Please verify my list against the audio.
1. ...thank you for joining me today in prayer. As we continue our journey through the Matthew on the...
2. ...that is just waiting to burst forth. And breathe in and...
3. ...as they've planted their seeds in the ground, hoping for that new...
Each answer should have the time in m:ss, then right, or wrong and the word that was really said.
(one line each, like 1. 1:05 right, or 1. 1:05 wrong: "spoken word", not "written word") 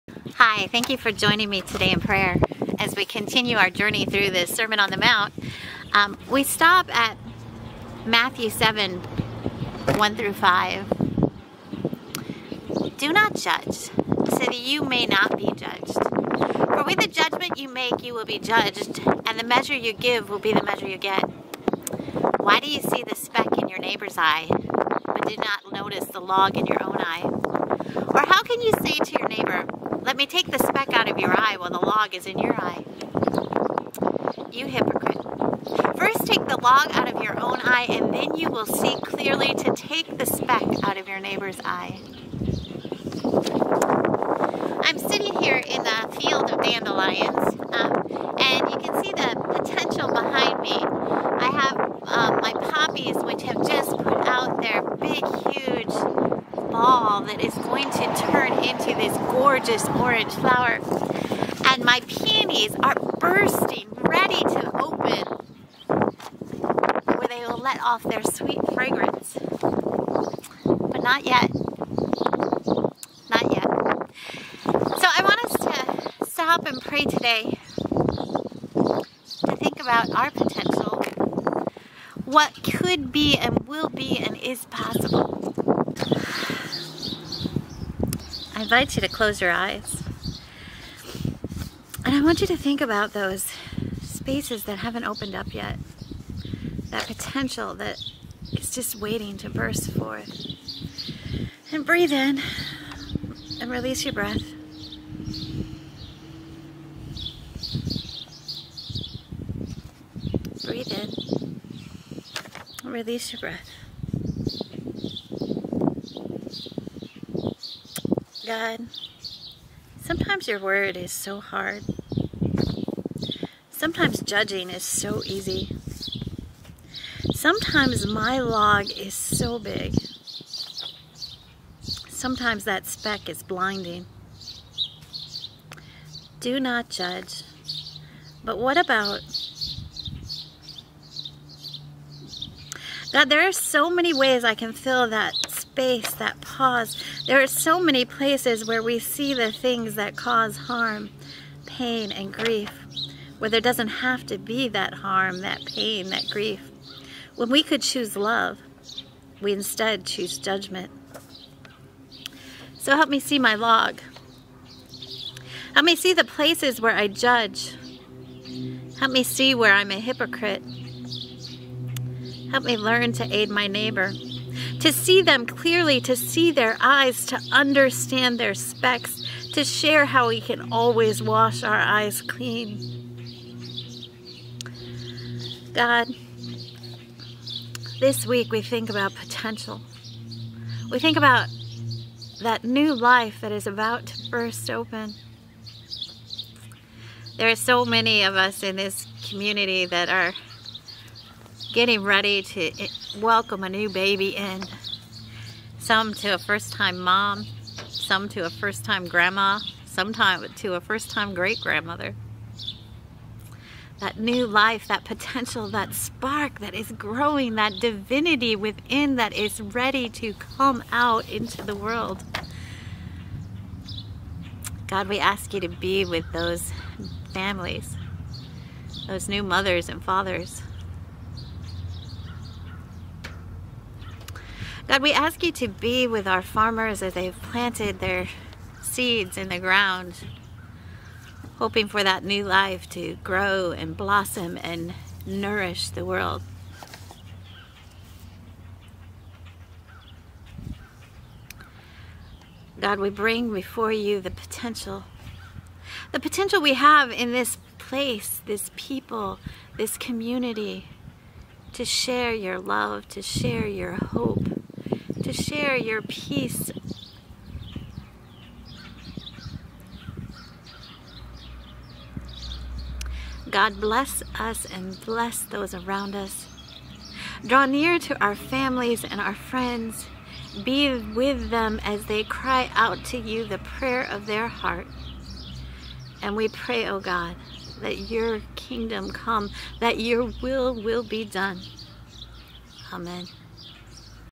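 1. 0:00 wrong: "Sermon", not "Matthew"
2. 1:37 right
3. 3:57 right.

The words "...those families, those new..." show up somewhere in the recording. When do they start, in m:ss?
3:46.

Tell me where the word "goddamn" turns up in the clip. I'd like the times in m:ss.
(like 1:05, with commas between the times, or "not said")
not said.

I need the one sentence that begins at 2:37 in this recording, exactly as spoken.
When we could choose love, we instead choose judgment.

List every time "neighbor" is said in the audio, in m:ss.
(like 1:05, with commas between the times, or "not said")
0:23, 0:41, 2:53.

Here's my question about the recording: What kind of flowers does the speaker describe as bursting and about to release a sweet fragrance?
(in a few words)
Peonies.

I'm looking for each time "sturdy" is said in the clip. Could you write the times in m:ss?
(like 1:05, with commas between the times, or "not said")
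not said.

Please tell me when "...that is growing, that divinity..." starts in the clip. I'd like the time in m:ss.
3:36.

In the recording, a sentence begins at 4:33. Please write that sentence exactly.
God bless us and bless those around us.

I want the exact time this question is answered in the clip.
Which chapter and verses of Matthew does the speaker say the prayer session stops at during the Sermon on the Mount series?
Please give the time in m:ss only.
0:08.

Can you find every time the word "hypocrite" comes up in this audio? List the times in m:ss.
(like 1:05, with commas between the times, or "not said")
0:34, 2:50.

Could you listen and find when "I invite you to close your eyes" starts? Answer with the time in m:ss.
1:28.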